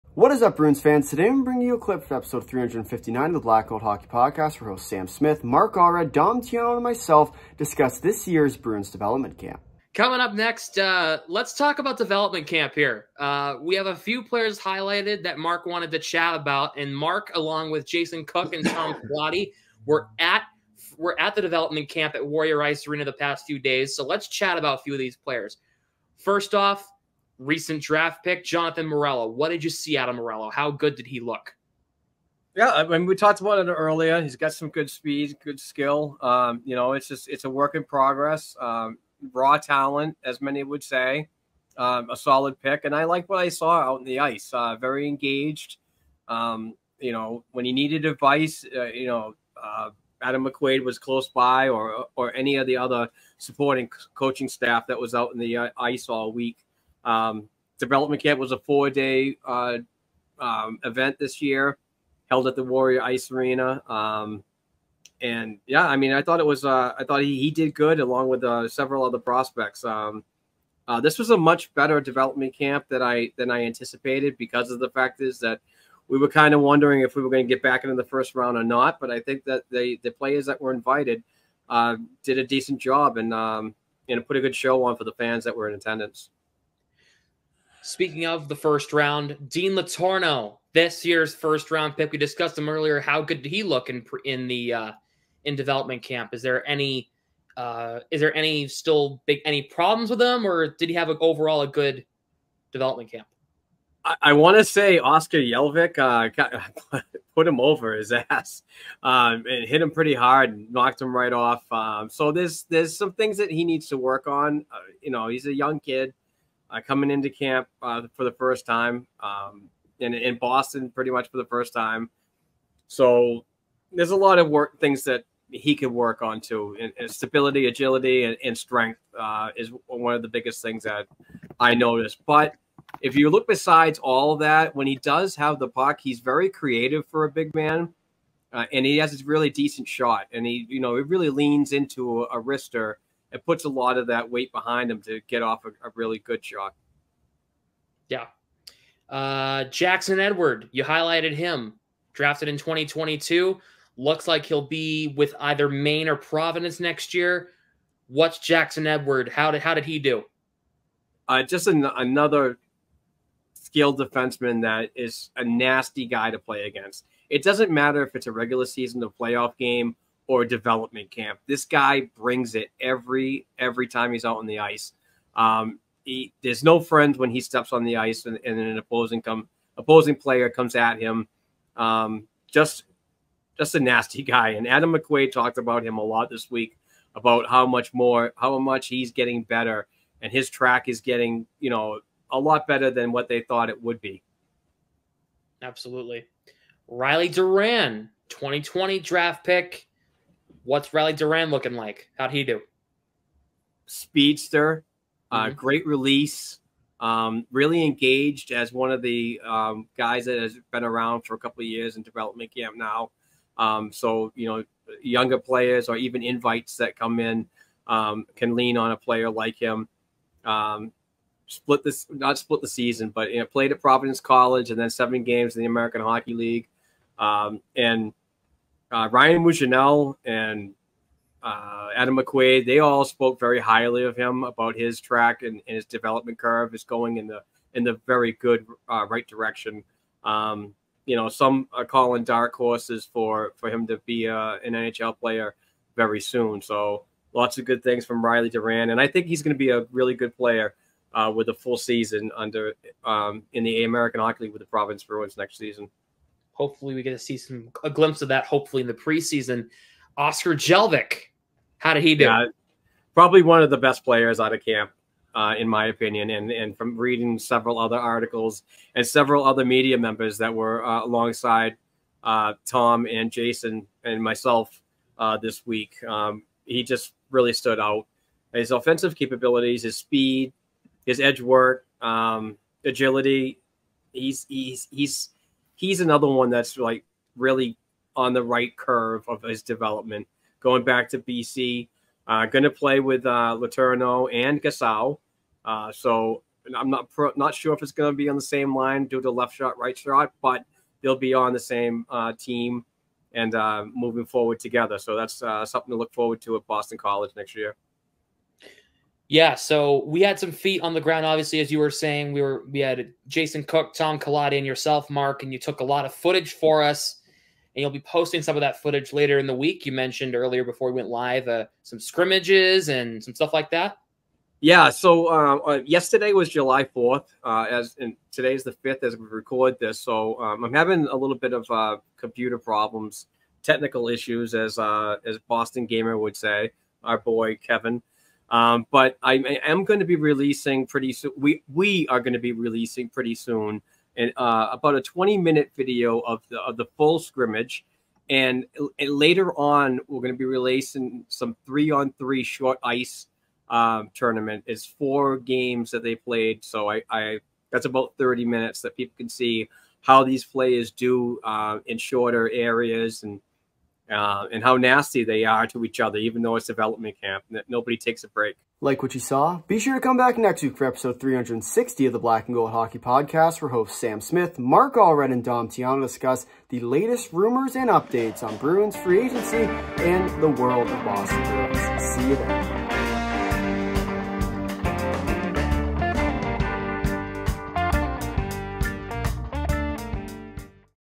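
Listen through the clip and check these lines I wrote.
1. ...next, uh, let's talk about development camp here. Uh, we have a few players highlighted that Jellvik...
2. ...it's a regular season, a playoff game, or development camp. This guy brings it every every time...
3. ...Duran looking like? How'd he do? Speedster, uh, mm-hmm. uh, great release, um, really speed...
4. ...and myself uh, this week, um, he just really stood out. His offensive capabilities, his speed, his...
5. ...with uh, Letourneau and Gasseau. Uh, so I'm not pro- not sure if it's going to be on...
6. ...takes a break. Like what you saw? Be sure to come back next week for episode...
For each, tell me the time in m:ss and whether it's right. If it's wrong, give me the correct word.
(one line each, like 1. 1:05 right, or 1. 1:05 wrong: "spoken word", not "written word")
1. 0:10 wrong: "Mark", not "Jellvik"
2. 2:48 right
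3. 3:21 wrong: "engaged", not "speed"
4. 4:34 right
5. 4:52 right
6. 6:07 right.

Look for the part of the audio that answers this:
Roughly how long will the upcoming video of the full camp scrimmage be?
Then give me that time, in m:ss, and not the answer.
5:45.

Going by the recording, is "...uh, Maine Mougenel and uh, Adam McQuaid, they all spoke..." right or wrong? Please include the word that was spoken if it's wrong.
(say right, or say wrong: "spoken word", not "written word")
wrong: "Ryan", not "Maine".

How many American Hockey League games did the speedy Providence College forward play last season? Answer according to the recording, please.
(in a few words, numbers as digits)
7.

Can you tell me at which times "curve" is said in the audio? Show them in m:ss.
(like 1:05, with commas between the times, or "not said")
3:56, 4:48.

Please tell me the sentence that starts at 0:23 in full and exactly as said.
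So let's chat about a few of these players.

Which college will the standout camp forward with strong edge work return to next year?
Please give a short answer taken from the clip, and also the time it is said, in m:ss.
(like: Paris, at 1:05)
Boston College, at 5:06.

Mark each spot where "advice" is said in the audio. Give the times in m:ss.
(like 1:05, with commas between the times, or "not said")
0:48.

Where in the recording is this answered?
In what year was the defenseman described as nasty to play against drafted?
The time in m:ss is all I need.
2:32.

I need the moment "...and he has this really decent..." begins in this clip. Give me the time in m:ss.
2:18.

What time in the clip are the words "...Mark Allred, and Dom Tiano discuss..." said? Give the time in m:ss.
6:14.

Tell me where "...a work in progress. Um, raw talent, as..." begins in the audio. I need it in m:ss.
0:37.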